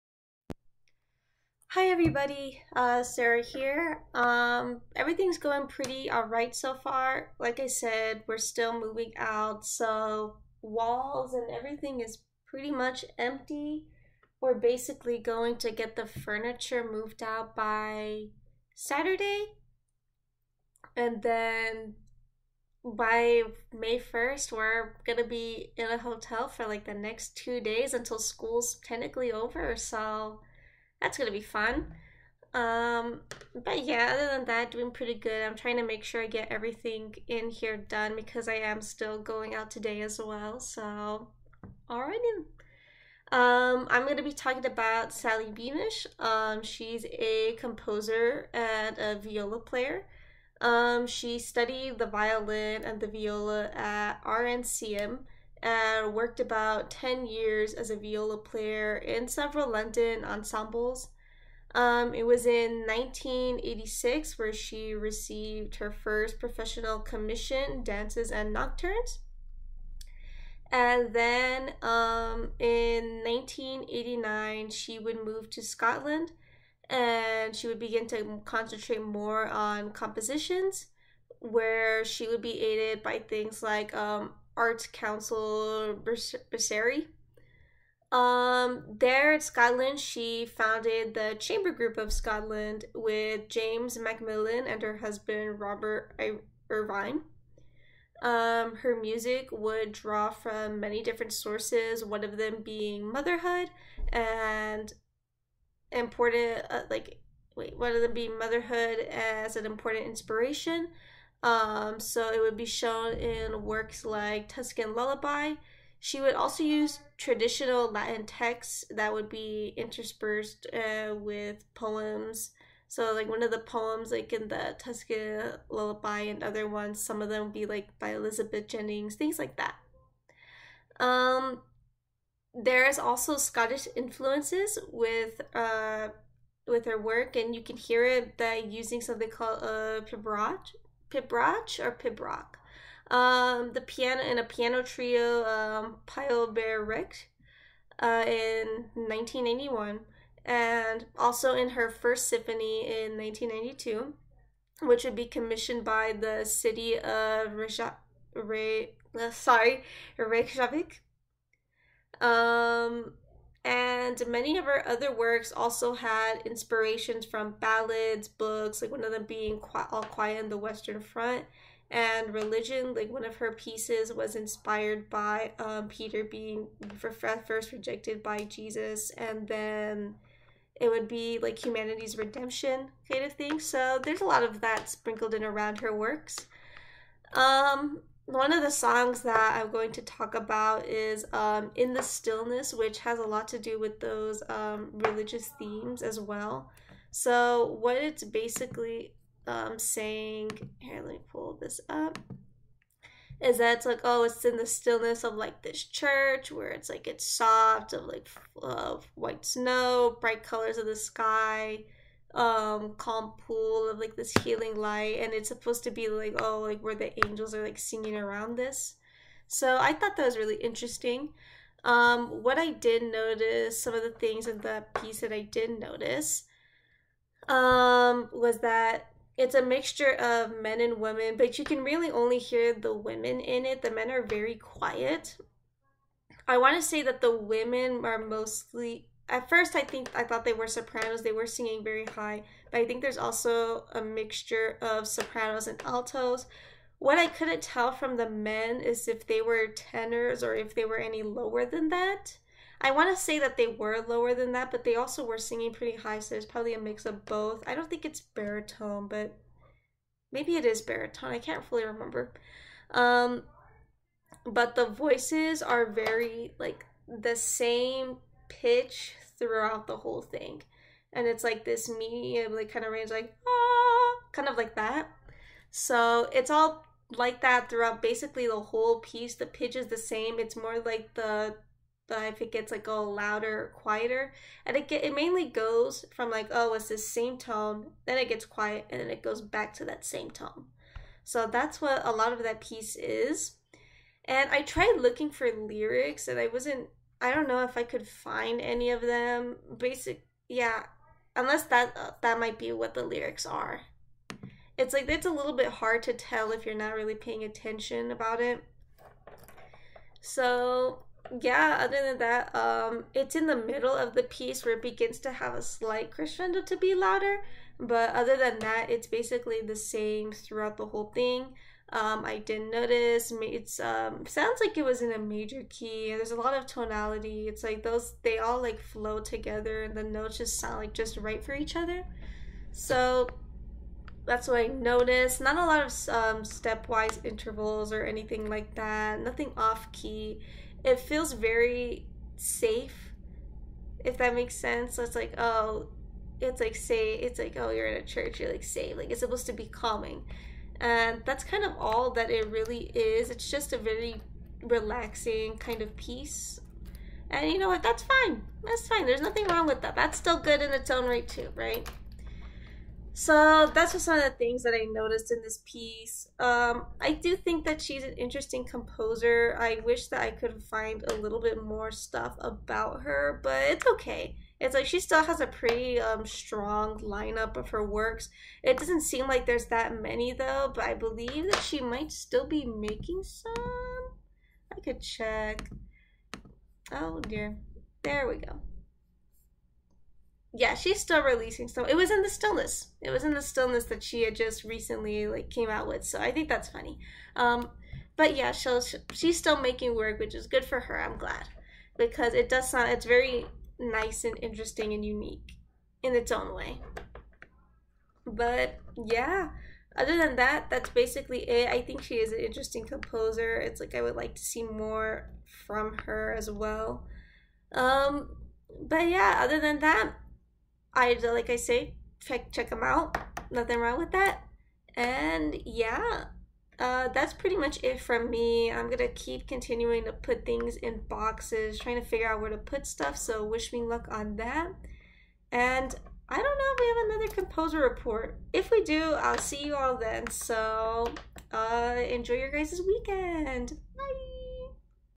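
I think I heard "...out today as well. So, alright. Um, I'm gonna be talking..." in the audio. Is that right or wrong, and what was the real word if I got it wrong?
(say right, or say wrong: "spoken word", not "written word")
right.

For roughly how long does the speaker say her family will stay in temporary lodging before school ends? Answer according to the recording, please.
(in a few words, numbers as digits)
2 days.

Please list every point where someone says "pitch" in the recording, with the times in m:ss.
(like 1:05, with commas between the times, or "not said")
4:28, 4:39.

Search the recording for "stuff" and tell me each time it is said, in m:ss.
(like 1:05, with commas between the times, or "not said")
6:11, 7:12.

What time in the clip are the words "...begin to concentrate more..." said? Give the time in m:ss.
1:17.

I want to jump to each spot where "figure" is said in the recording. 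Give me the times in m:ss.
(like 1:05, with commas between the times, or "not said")
7:12.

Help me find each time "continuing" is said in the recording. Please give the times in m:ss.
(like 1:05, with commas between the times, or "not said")
7:09.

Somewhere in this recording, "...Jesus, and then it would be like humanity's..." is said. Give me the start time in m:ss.
2:58.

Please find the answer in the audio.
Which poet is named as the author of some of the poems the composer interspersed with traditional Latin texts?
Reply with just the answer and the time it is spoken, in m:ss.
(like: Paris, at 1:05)
Elizabeth Jennings, at 2:08.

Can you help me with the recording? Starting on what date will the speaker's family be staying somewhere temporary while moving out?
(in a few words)
May 1.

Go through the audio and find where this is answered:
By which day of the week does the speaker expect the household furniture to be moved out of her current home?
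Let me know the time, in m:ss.
0:18.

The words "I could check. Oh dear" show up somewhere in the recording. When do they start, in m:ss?
6:24.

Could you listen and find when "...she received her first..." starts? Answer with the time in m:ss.
1:04.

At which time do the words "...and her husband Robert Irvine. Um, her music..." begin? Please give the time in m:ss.
1:34.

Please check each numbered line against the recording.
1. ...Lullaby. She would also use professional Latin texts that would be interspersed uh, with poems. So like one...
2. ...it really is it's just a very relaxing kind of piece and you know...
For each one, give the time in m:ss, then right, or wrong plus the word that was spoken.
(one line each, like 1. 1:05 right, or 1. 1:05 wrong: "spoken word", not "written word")
1. 1:54 wrong: "traditional", not "professional"
2. 5:52 right.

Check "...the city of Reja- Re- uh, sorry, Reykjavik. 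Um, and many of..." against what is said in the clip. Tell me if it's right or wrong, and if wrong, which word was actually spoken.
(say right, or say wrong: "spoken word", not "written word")
right.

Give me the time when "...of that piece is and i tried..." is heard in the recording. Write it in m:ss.
4:52.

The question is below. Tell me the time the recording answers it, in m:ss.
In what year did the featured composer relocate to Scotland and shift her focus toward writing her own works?
1:13.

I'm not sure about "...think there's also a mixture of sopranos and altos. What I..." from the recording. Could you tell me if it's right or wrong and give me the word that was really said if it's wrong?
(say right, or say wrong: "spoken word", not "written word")
right.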